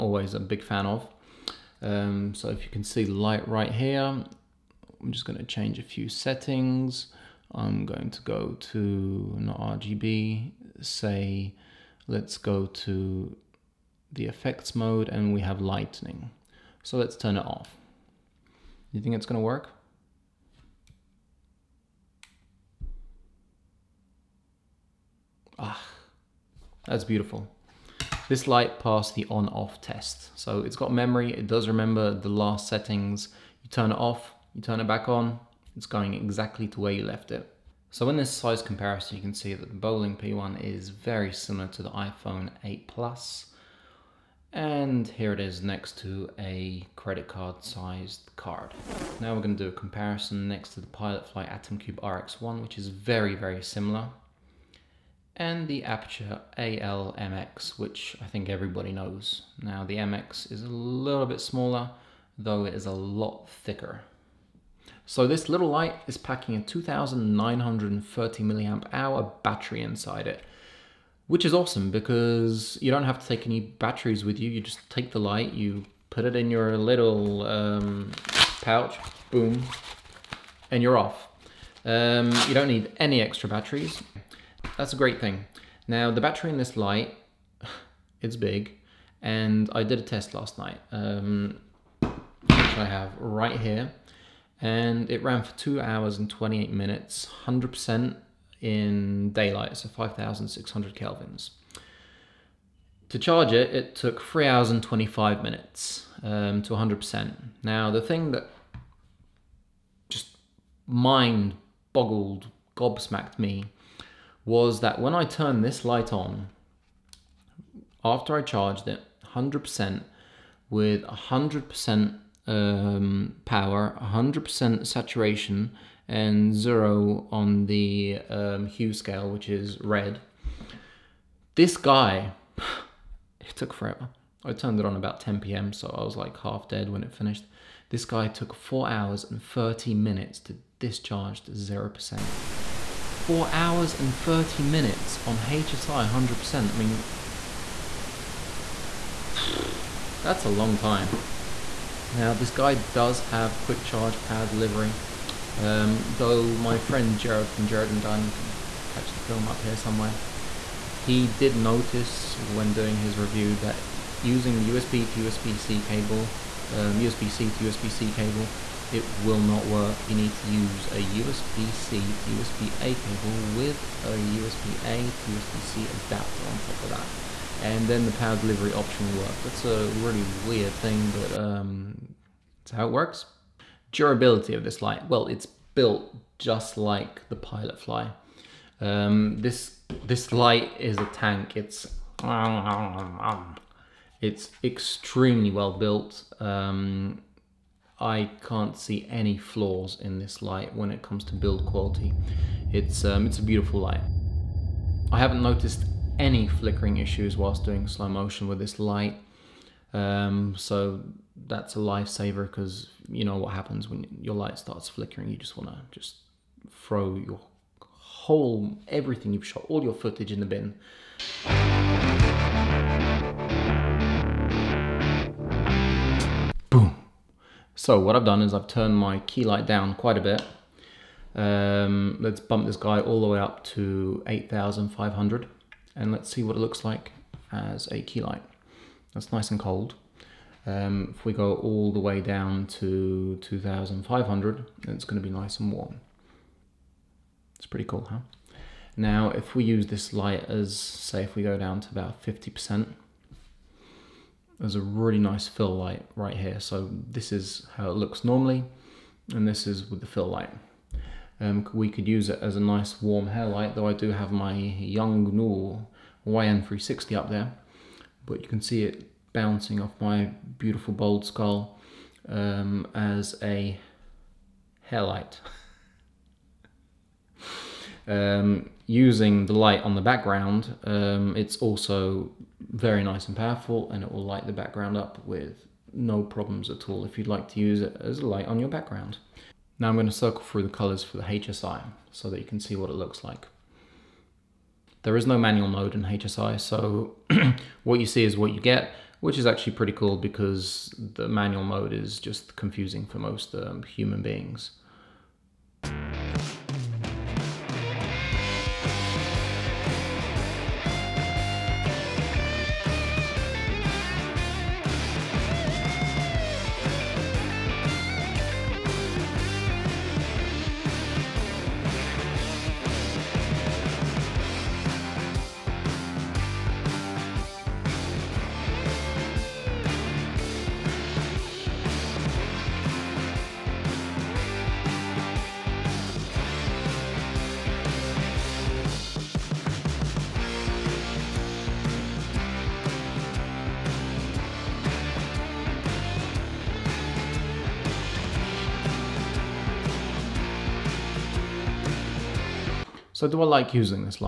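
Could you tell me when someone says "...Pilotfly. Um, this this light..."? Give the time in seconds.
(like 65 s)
187 s.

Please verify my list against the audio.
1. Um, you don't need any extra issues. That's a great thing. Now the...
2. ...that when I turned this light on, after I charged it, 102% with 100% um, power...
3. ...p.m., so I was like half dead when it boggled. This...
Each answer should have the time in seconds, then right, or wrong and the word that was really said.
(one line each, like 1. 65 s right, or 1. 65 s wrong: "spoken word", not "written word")
1. 81 s wrong: "batteries", not "issues"
2. 114 s wrong: "100", not "102"
3. 135 s wrong: "finished", not "boggled".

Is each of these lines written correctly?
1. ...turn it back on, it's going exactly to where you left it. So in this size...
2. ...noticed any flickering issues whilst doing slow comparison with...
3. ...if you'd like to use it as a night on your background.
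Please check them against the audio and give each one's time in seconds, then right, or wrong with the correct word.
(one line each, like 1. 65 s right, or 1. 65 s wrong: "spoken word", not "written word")
1. 34 s right
2. 205 s wrong: "motion", not "comparison"
3. 287 s wrong: "light", not "night".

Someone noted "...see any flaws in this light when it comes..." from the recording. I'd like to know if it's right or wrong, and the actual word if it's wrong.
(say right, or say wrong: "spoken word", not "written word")
right.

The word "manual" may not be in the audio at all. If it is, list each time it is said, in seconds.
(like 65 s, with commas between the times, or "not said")
295 s, 301 s.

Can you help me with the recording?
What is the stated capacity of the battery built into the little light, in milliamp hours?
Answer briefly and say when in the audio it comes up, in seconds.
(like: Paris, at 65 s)
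2930, at 66 s.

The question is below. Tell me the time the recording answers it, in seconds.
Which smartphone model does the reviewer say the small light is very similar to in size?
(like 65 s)
41 s.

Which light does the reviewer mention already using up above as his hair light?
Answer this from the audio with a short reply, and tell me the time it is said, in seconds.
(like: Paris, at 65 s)
Yongnuo YN360, at 264 s.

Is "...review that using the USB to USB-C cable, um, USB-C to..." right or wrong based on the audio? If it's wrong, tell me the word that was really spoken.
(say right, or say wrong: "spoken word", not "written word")
right.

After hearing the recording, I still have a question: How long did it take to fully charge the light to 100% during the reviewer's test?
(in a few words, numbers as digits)
3 hours 25 minutes.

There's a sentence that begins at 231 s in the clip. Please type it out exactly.
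Um, let's bump this guy all the way up to 8,500 and let's see what it looks like as a key light.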